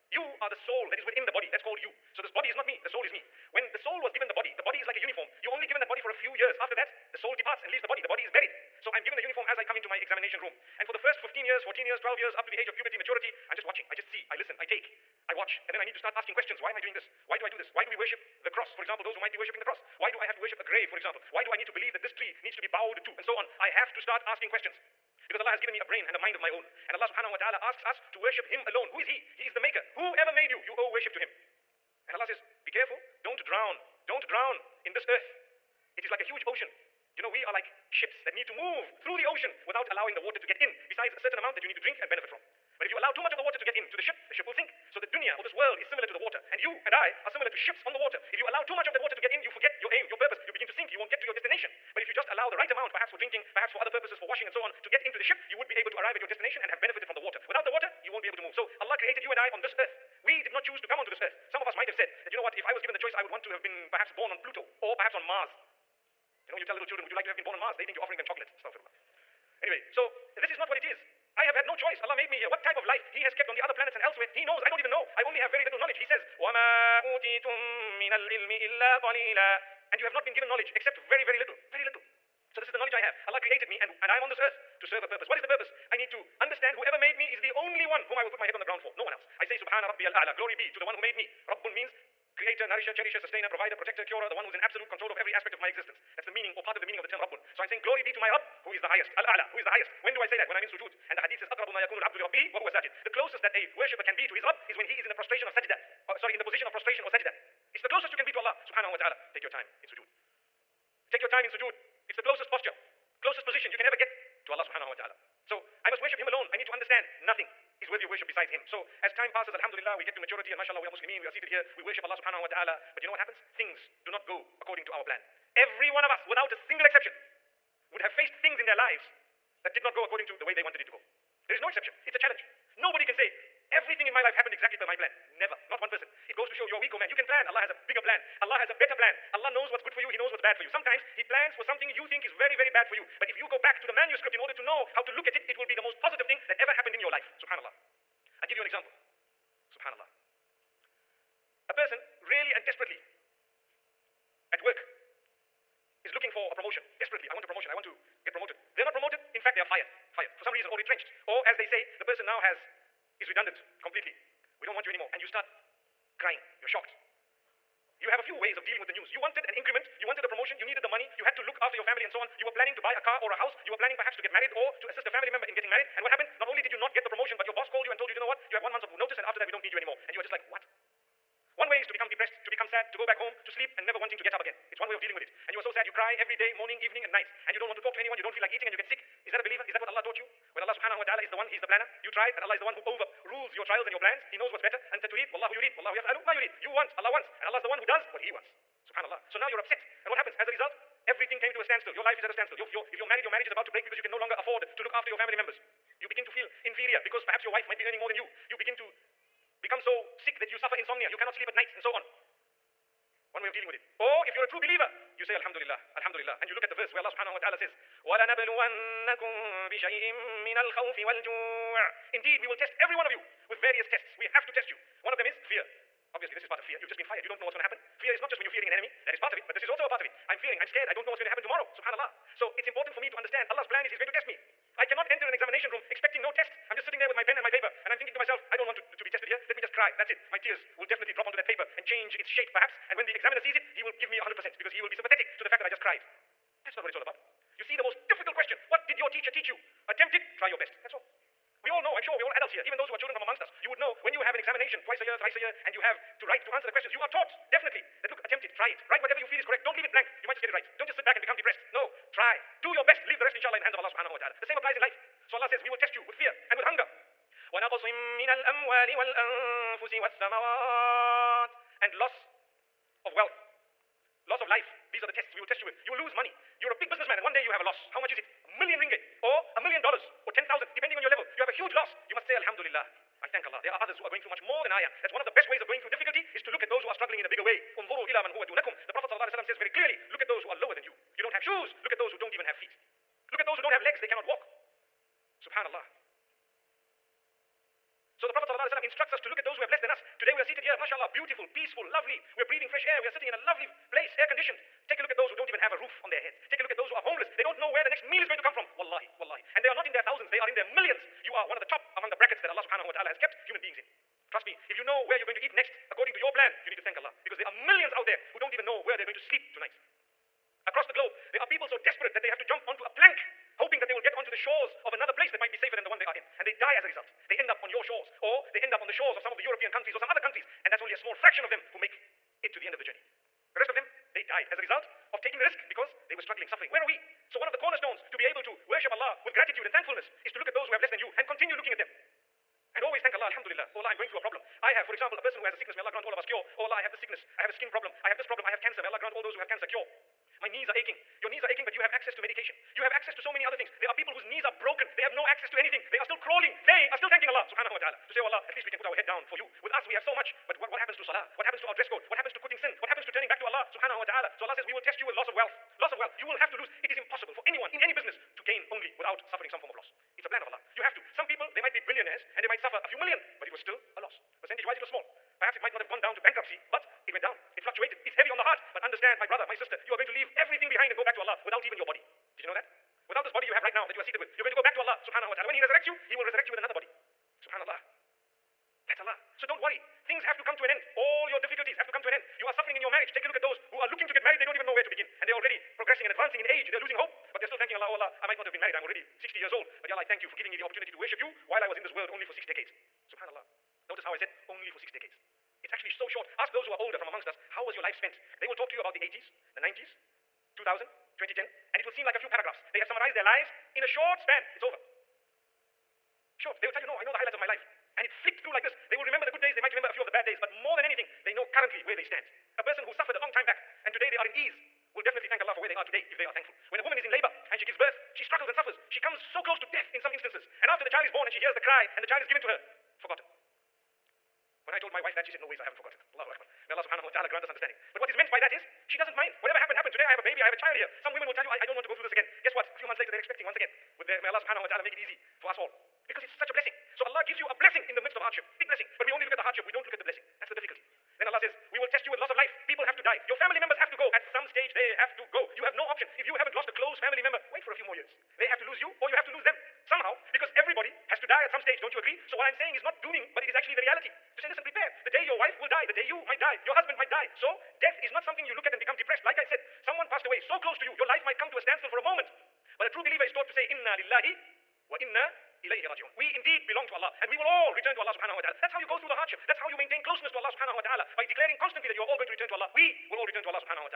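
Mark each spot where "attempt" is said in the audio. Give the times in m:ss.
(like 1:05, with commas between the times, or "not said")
4:09, 4:18.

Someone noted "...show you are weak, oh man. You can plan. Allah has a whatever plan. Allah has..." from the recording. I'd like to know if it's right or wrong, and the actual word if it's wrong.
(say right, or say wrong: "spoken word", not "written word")
wrong: "bigger", not "whatever".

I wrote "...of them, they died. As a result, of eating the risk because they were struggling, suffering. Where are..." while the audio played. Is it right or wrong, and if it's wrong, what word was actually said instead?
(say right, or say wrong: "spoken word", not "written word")
wrong: "taking", not "eating".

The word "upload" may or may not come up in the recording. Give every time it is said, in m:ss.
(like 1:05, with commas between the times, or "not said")
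not said.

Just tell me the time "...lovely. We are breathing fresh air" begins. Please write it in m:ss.
5:01.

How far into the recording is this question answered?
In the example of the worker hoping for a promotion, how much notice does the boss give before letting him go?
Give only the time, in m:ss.
2:58.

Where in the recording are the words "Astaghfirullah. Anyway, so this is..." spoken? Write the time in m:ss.
1:08.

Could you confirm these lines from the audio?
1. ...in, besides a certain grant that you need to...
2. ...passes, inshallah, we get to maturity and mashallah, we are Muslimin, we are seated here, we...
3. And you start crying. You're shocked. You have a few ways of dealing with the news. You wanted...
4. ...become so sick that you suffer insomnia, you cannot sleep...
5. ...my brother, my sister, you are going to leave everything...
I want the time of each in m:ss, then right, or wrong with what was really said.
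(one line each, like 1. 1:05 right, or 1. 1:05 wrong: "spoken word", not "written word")
1. 0:40 wrong: "amount", not "grant"
2. 1:59 wrong: "alhamdulillah", not "inshallah"
3. 2:45 right
4. 3:29 right
5. 6:19 right.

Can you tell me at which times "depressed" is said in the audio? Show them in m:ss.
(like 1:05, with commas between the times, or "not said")
3:02, 4:21, 7:48.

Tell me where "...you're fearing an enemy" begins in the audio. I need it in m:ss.
3:48.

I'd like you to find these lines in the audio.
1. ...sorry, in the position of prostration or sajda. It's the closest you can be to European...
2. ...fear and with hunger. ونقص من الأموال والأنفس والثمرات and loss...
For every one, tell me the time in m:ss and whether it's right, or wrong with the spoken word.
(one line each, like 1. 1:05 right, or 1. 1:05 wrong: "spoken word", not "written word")
1. 1:46 wrong: "Allah", not "European"
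2. 4:26 right.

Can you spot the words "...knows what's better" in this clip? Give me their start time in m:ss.
3:14.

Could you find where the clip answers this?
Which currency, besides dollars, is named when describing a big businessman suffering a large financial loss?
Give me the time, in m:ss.
4:38.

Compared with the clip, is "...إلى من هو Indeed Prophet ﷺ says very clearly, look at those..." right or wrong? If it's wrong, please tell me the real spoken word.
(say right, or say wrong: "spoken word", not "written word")
wrong: "The", not "Indeed".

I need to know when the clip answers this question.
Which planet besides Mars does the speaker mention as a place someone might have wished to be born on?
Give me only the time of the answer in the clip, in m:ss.
1:04.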